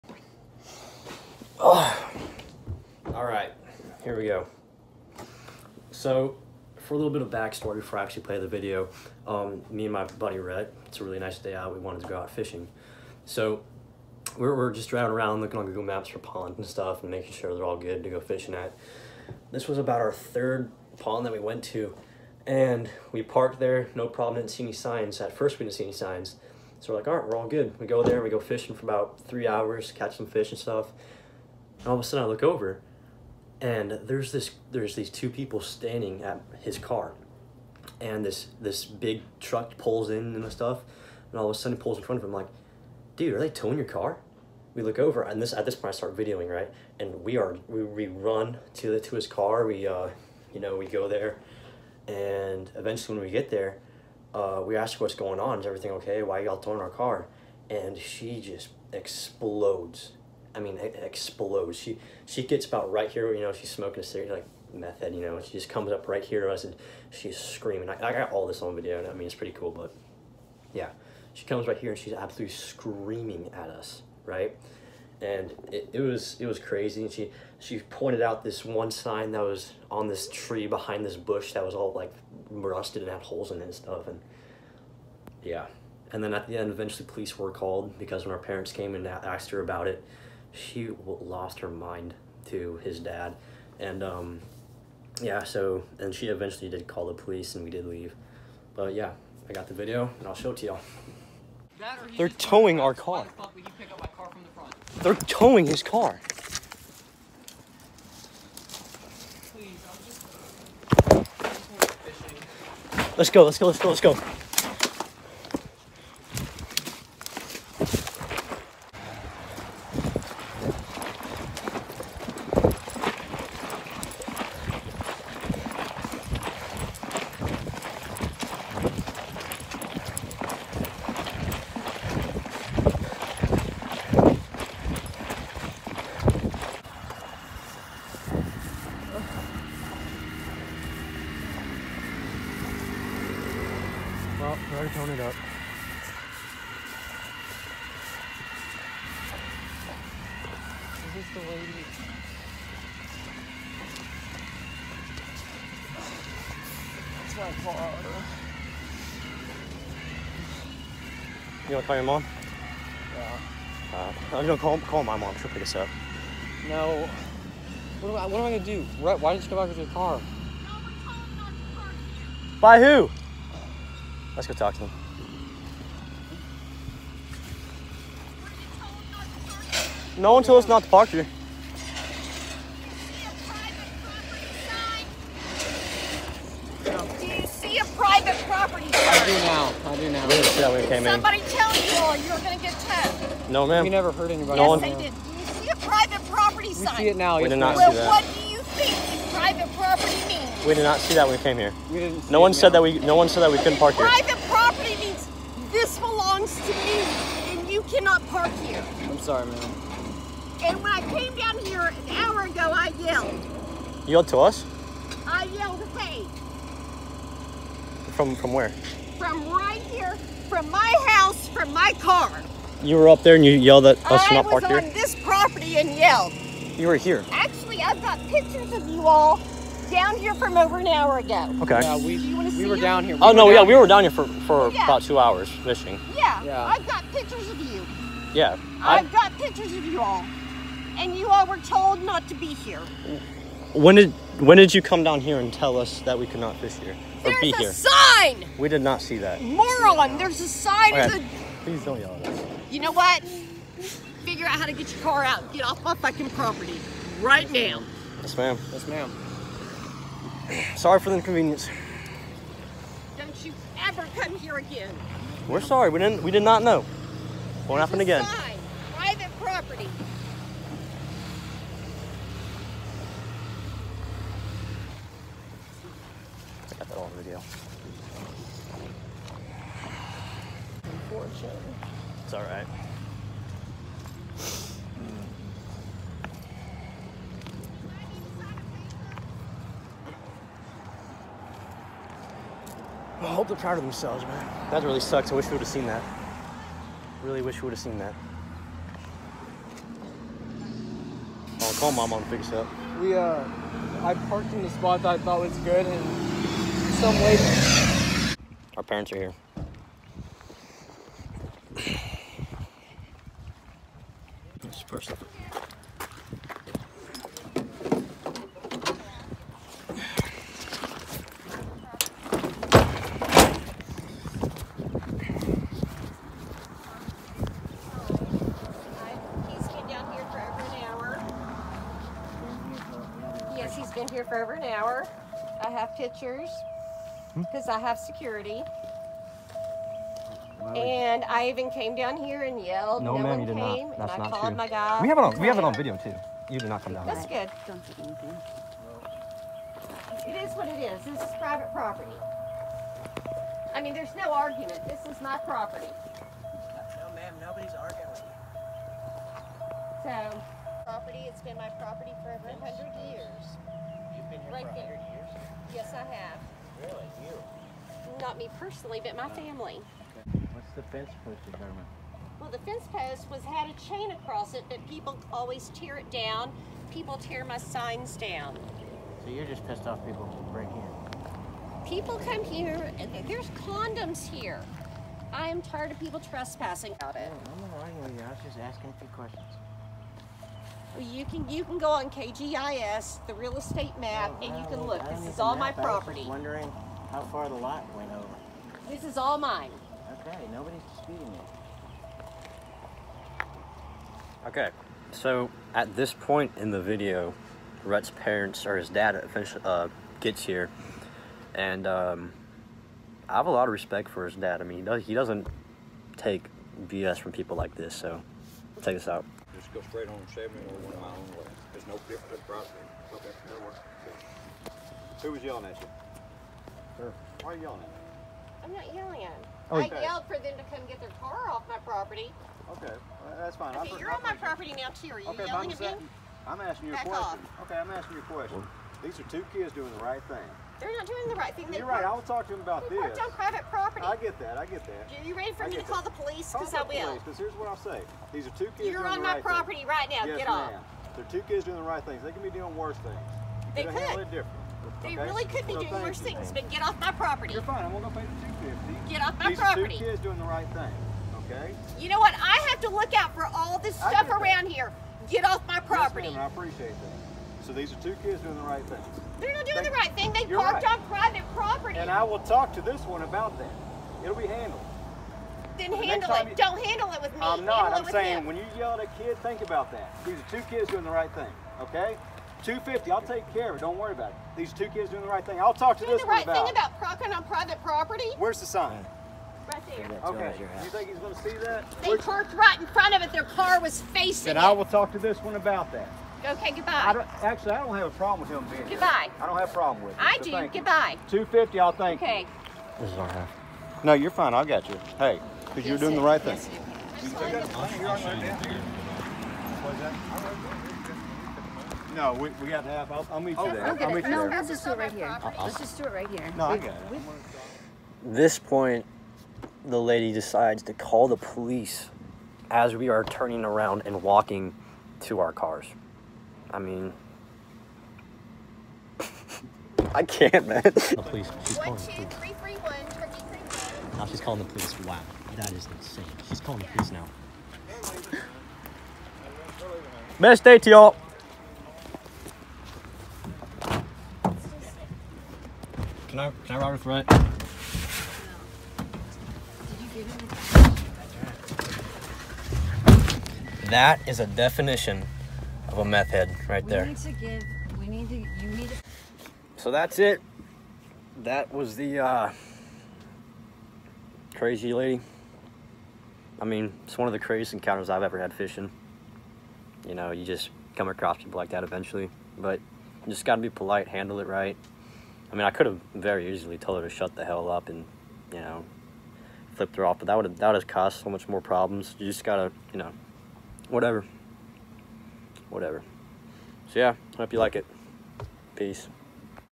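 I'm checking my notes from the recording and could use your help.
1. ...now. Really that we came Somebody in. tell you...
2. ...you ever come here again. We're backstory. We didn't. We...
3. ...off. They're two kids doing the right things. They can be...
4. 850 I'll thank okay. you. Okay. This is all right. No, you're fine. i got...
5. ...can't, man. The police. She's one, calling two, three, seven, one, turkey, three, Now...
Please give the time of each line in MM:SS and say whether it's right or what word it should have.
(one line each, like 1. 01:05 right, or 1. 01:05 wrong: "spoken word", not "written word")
1. 03:10 right
2. 04:23 wrong: "sorry", not "backstory"
3. 07:30 right
4. 08:21 wrong: "250", not "850"
5. 08:50 wrong: "three", not "seven".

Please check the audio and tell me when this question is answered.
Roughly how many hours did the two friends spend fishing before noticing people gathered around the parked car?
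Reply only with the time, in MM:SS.
00:29.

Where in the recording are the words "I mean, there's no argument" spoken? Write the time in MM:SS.
05:53.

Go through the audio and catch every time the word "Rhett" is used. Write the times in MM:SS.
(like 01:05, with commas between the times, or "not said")
00:10, 06:47, 09:07.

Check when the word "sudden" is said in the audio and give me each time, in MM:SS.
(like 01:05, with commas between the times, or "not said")
00:32, 00:41.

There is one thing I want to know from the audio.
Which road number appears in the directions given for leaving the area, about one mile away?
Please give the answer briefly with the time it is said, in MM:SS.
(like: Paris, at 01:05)
70, at 07:00.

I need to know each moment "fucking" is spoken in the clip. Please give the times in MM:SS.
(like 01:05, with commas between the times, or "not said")
04:15.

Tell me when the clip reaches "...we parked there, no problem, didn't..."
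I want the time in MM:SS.
00:23.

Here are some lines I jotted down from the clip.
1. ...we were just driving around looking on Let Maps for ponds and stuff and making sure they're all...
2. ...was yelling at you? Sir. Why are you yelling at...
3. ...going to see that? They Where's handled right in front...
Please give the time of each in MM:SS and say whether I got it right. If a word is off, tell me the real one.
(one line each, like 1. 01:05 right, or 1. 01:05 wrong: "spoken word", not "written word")
1. 00:14 wrong: "Google", not "Let"
2. 07:05 right
3. 08:11 wrong: "parked", not "handled".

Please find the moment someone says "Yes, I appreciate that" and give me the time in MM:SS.
07:46.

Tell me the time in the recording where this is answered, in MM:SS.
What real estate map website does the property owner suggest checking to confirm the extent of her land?
06:32.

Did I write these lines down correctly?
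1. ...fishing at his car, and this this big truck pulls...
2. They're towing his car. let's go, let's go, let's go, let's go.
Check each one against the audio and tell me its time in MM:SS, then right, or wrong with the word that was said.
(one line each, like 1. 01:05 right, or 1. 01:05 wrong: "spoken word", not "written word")
1. 00:35 wrong: "standing", not "fishing"
2. 01:45 right.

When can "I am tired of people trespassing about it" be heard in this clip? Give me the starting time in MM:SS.
06:25.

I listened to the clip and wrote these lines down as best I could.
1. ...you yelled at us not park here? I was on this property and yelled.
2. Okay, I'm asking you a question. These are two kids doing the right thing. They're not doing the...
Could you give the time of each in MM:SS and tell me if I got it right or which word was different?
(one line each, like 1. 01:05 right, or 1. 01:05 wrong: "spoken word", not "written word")
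1. 03:43 right
2. 07:17 right.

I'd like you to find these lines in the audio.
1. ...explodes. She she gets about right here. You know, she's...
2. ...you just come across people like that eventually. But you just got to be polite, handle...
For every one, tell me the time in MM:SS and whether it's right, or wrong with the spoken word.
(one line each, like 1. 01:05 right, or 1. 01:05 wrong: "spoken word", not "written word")
1. 01:01 right
2. 09:30 right.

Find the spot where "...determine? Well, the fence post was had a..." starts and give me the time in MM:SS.
06:11.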